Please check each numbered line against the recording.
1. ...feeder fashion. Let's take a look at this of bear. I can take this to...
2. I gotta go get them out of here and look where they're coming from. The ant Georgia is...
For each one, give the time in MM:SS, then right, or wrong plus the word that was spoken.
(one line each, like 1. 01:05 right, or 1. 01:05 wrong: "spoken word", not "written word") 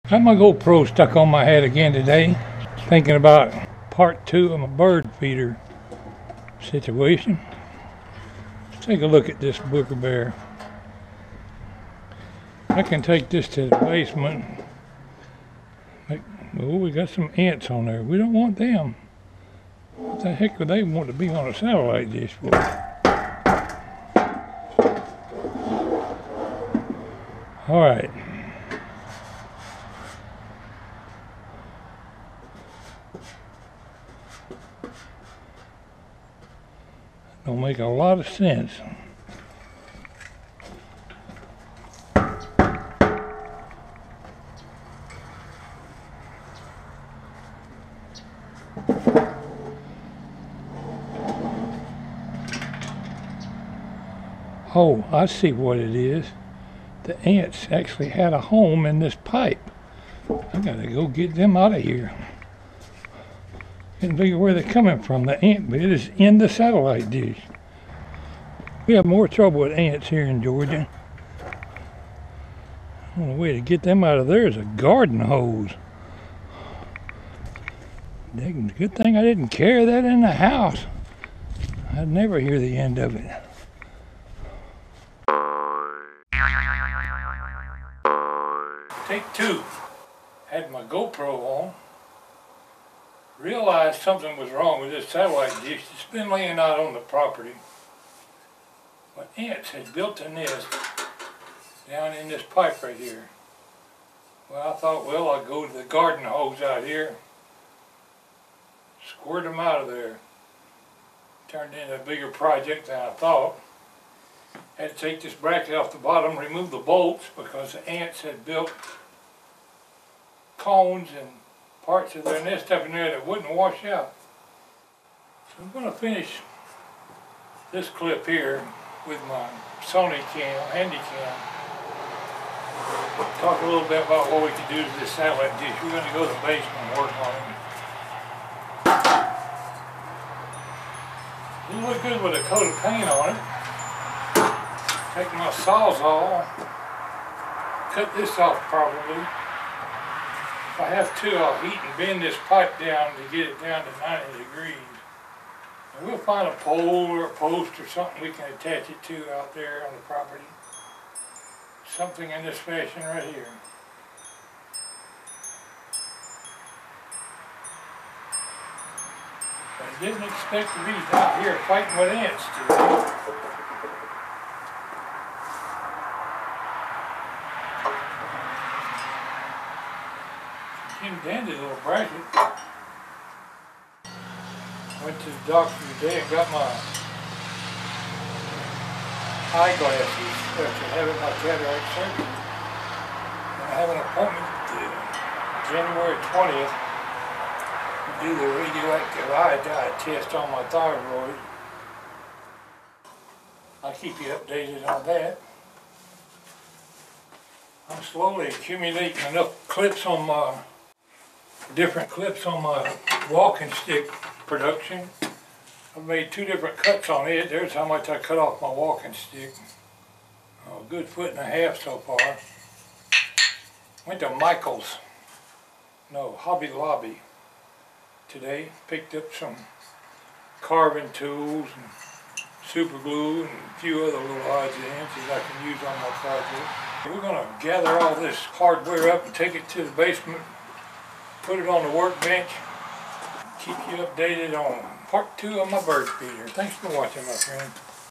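1. 00:05 wrong: "situation", not "fashion"
2. 01:00 wrong: "But", not "Georgia".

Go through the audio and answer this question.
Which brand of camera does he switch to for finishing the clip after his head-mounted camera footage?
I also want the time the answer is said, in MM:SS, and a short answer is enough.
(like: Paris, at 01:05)
Sony, at 02:09.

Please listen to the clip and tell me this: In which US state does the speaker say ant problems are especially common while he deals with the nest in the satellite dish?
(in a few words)
Georgia.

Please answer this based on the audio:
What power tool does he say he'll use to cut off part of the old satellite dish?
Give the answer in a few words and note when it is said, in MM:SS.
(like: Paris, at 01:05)
Sawzall, at 02:25.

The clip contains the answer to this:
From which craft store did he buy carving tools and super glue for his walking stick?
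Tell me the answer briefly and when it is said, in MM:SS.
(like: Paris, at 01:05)
Hobby Lobby, at 03:46.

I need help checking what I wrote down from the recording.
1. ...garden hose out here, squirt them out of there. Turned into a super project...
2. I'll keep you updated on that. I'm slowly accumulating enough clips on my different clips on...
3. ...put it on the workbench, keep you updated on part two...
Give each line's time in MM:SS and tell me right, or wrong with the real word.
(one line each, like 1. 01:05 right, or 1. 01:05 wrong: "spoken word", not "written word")
1. 01:45 wrong: "bigger", not "super"
2. 03:23 right
3. 04:01 right.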